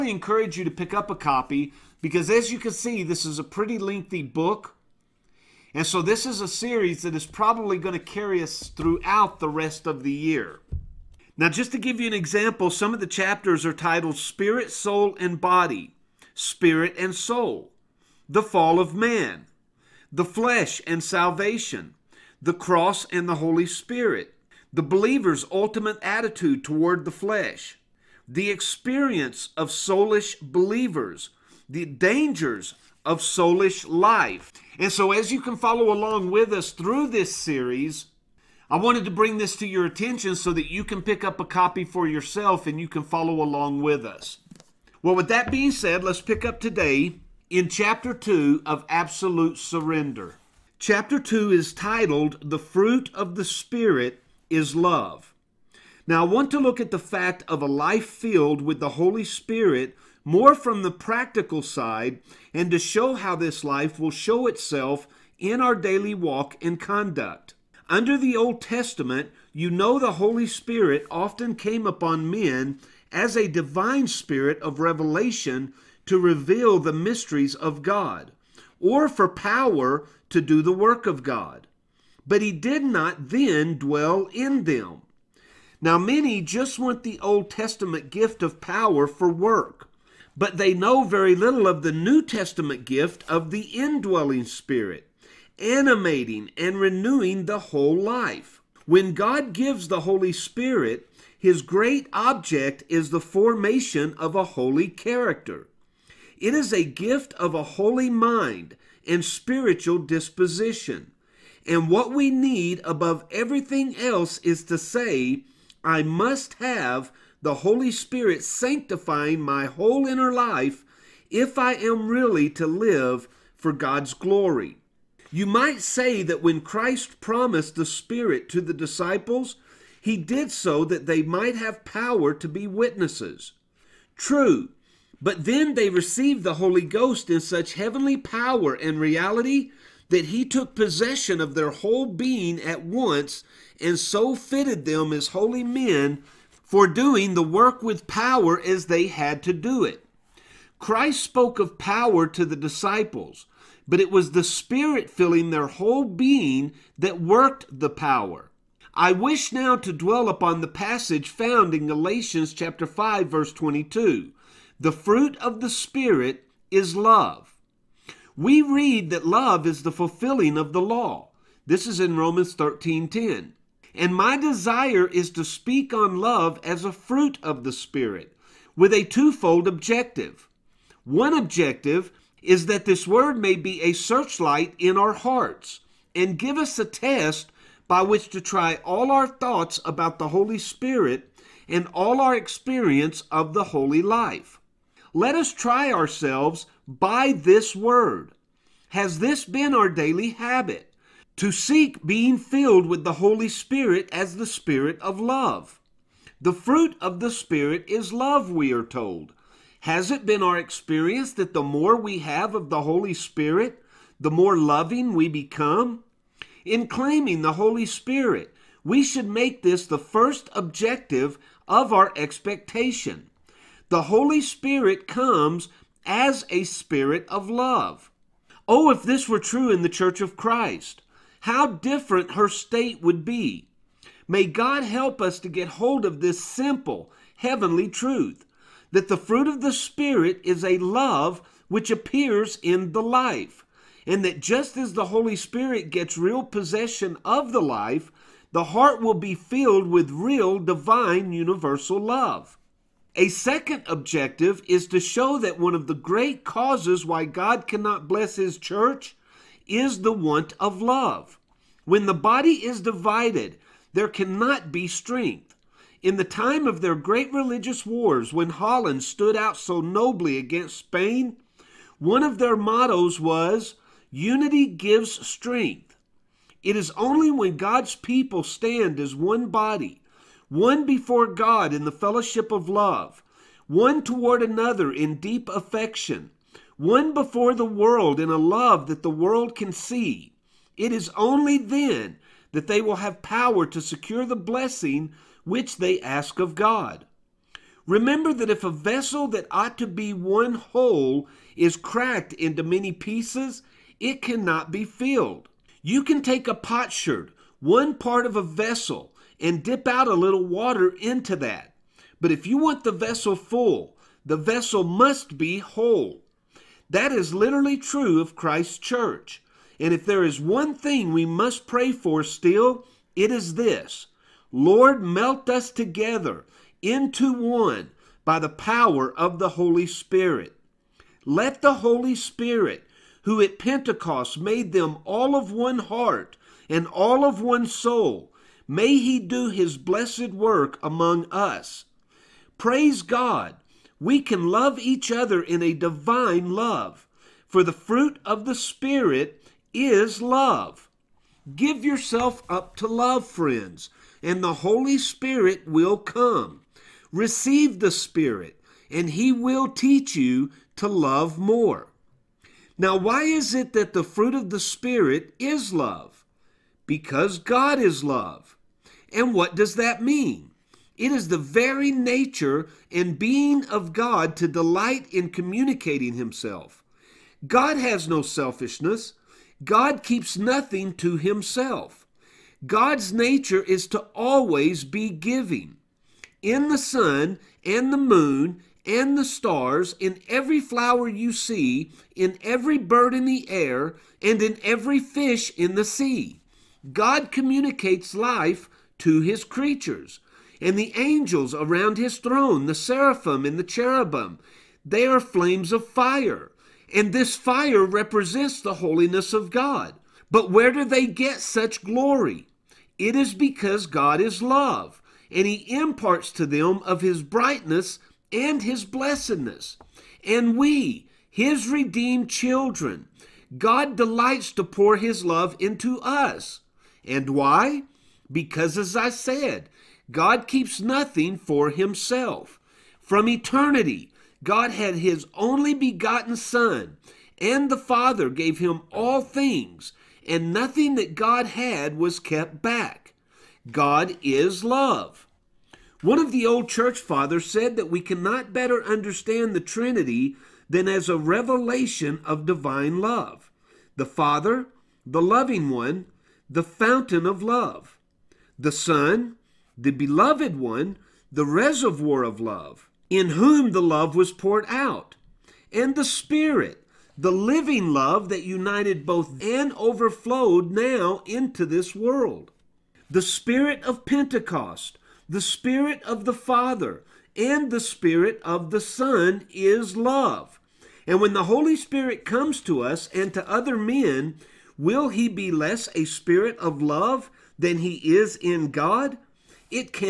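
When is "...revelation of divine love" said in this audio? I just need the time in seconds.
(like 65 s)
451 s.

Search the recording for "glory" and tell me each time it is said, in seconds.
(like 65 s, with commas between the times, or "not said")
124 s, 411 s.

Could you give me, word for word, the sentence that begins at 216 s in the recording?
In claiming the Holy Spirit, we should make this the first objective of our expectation.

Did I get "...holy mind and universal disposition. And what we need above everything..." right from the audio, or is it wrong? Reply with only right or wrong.
wrong.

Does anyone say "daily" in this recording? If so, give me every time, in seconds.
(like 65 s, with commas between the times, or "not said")
65 s, 199 s.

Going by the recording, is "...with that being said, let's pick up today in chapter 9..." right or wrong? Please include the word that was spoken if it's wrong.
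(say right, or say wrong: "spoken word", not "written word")
wrong: "2", not "9".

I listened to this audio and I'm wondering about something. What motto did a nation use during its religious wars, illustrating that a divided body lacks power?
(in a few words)
Unity gives strength.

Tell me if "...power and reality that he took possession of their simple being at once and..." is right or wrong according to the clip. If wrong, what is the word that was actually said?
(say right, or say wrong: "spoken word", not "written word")
wrong: "whole", not "simple".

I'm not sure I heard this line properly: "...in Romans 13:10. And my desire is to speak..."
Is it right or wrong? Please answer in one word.
right.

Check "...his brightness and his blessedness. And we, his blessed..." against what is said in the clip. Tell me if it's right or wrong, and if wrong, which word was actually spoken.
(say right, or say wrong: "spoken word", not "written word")
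wrong: "redeemed", not "blessed".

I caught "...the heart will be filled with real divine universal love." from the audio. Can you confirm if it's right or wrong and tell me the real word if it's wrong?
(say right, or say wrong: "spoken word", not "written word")
right.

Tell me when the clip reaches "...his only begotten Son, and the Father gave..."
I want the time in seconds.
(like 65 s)
434 s.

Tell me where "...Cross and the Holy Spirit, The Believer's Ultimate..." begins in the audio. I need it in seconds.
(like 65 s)
22 s.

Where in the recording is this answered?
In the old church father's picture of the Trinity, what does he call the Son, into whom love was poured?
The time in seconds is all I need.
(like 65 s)
461 s.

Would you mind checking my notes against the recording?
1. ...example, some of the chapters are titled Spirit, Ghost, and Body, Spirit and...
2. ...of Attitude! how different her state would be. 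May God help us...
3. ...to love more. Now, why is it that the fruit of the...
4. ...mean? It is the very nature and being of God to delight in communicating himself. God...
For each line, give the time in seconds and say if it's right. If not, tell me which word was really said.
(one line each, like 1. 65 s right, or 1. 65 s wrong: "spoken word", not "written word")
1. 12 s wrong: "Soul", not "Ghost"
2. 230 s wrong: "Christ", not "Attitude"
3. 360 s right
4. 370 s right.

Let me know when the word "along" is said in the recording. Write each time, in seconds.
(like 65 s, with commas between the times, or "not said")
35 s, 43 s.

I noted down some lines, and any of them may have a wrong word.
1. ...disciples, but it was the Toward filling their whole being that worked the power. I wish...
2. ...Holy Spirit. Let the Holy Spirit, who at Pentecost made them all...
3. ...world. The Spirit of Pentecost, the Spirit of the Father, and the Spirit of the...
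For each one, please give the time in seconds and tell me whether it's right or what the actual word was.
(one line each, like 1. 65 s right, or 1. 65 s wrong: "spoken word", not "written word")
1. 152 s wrong: "Spirit", not "Toward"
2. 329 s right
3. 471 s right.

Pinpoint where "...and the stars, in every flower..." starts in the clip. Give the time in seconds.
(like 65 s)
388 s.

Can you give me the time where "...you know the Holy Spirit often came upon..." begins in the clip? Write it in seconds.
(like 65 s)
69 s.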